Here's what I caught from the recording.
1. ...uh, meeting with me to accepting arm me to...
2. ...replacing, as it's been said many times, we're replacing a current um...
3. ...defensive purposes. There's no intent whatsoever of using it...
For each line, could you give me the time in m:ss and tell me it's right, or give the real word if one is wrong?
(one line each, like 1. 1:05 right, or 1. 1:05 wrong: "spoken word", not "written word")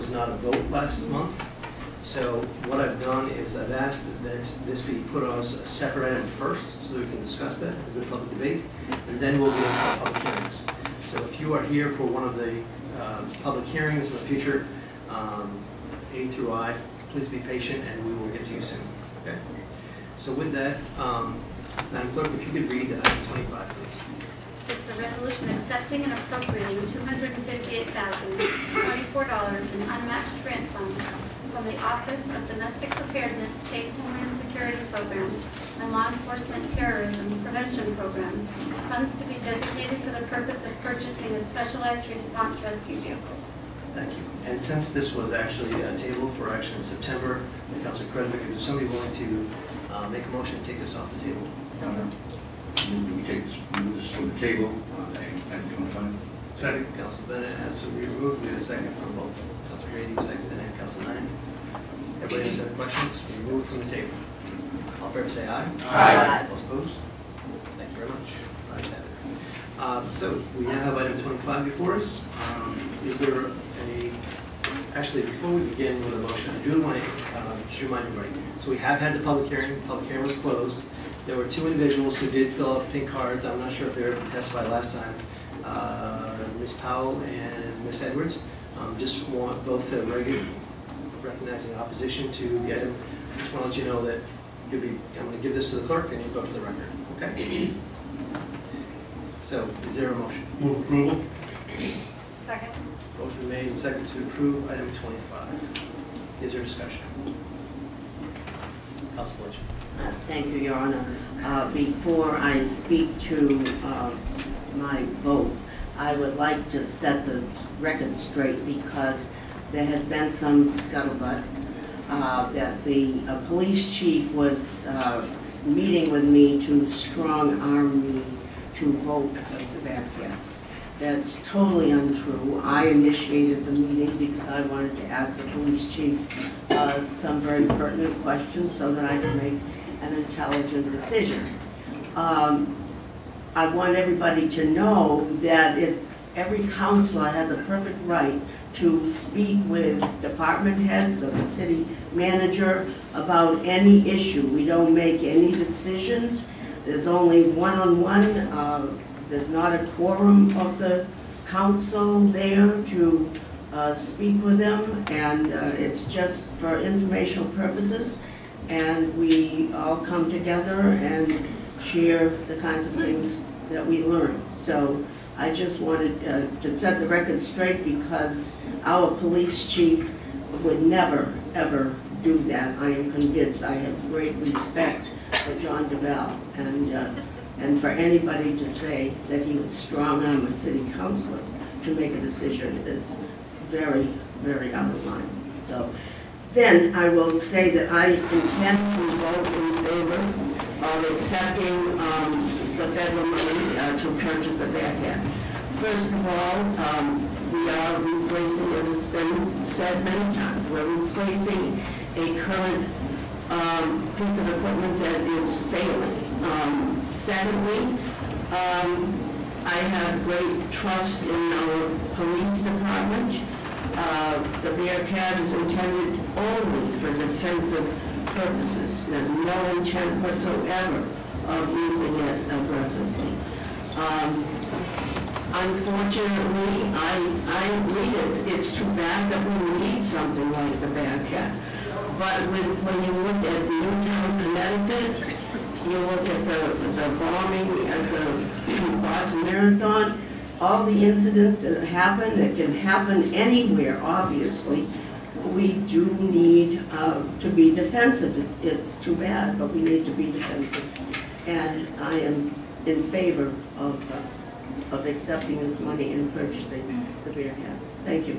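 1. 2:04 wrong: "strong", not "accepting"
2. 3:28 right
3. 3:47 right.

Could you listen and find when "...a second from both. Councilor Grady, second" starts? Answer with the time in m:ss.
0:58.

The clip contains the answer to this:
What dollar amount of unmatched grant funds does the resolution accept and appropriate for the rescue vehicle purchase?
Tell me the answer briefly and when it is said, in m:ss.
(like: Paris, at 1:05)
$258,024, at 0:26.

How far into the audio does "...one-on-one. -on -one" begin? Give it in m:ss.
2:37.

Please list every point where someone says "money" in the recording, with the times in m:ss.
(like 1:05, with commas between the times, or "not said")
3:23, 4:25.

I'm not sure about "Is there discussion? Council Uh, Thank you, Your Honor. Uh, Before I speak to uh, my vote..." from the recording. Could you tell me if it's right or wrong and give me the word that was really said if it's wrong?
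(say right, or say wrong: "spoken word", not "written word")
right.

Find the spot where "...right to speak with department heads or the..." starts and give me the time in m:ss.
2:28.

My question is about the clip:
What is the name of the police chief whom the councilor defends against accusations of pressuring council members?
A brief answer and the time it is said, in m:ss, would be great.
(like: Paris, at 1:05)
John Duval, at 3:05.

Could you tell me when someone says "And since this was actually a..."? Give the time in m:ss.
0:44.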